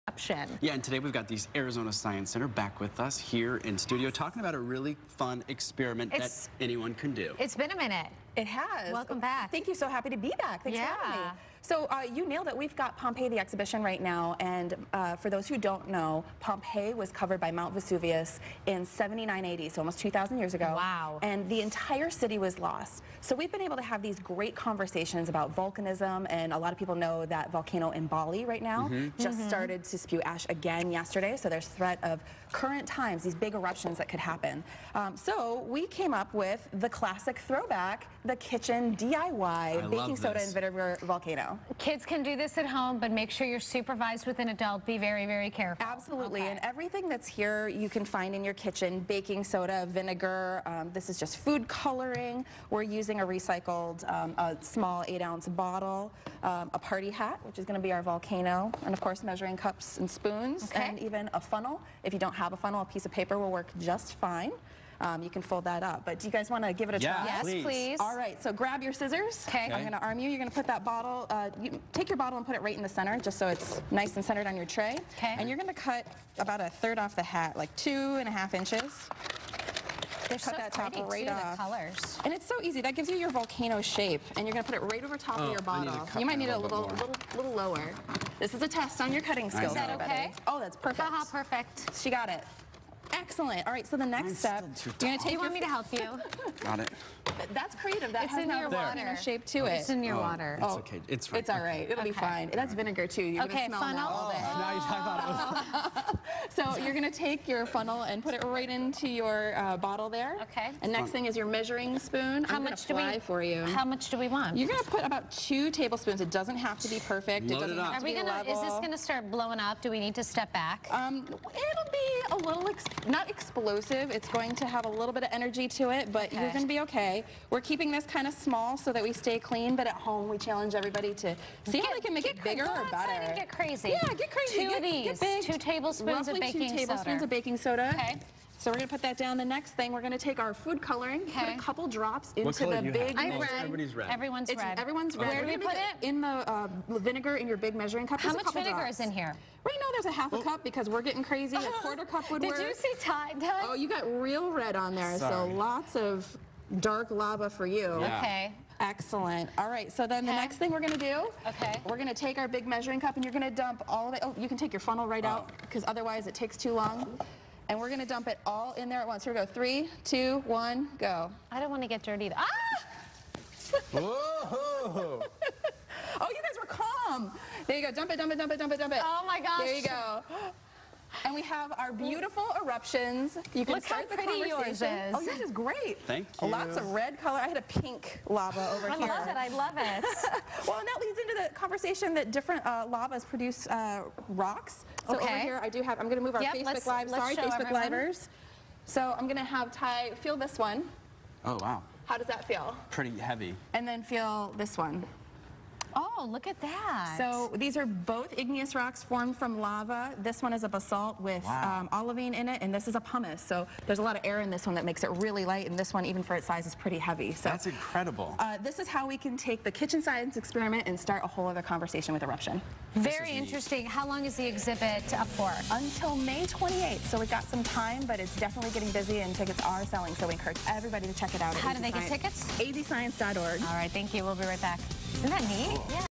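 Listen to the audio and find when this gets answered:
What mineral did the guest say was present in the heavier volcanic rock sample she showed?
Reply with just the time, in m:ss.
3:31.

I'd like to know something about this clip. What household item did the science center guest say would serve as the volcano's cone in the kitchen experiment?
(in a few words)
Party hat.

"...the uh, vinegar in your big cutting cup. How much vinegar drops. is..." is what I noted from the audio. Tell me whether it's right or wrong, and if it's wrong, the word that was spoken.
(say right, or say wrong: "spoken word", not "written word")
wrong: "measuring", not "cutting".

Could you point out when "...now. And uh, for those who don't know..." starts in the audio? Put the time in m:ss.
0:14.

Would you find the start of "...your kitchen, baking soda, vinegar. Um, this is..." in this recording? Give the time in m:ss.
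0:48.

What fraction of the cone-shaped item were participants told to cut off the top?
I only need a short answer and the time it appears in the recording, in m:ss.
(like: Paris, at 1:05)
A third, at 1:16.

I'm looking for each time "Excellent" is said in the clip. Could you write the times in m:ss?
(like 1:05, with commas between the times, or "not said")
1:33, 2:38.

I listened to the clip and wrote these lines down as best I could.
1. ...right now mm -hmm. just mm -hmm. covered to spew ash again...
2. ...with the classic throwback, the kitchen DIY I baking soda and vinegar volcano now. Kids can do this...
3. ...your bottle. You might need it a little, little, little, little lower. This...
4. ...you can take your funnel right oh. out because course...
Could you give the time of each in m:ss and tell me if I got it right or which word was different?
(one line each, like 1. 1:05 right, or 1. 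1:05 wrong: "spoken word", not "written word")
1. 0:28 wrong: "started", not "covered"
2. 0:36 right
3. 1:25 right
4. 2:44 wrong: "otherwise", not "course".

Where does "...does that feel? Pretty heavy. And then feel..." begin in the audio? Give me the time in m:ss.
3:22.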